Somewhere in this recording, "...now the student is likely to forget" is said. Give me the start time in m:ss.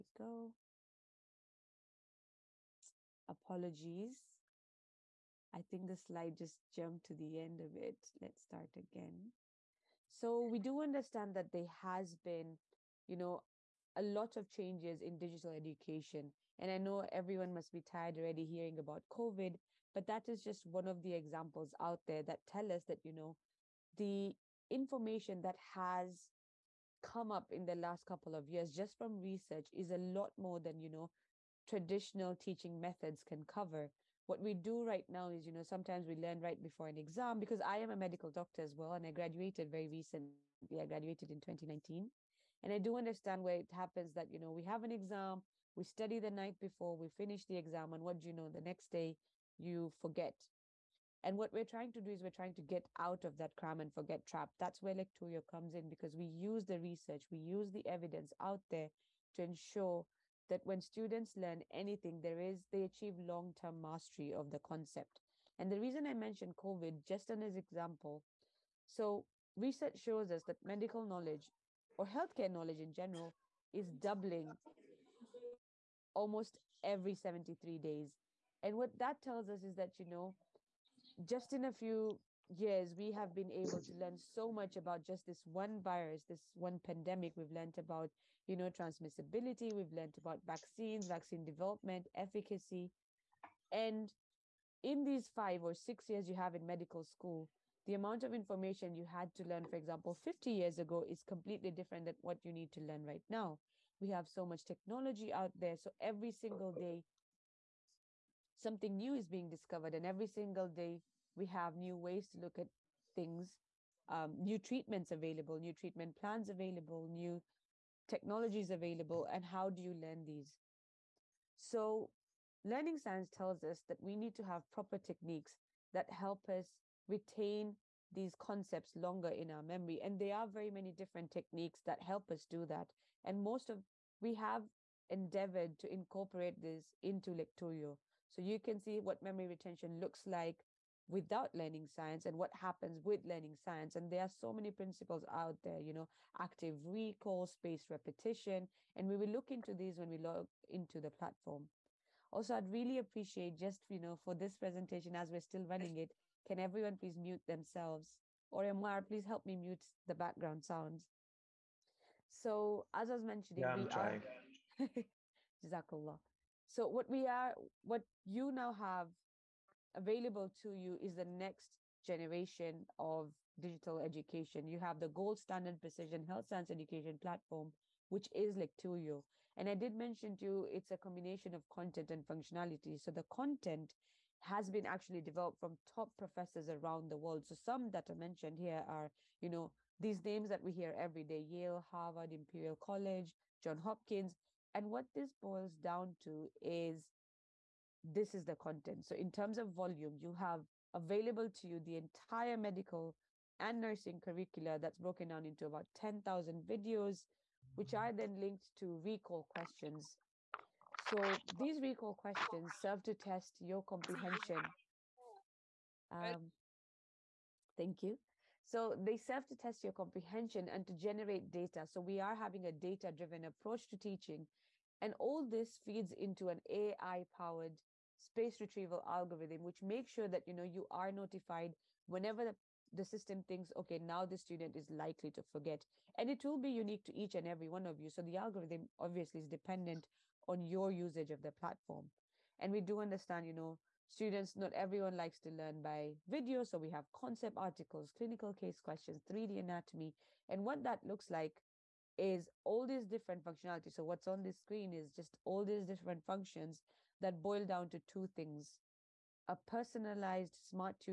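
3:53.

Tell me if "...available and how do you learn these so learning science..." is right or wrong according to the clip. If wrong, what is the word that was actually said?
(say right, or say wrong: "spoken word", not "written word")
right.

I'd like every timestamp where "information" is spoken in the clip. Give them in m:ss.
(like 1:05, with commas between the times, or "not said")
0:24, 1:38.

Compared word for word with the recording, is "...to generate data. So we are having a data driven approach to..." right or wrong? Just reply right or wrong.
right.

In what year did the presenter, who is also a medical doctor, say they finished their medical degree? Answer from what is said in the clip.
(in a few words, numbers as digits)
2019.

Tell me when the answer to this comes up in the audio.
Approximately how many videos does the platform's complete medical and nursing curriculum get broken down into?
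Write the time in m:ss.
3:25.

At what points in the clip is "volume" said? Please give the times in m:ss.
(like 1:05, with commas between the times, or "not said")
3:19.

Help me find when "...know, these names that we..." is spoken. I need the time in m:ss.
3:09.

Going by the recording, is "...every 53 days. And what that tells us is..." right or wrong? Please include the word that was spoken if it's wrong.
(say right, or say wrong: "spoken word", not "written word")
wrong: "73", not "53".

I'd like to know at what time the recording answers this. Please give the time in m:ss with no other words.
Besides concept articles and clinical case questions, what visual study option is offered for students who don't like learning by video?
4:09.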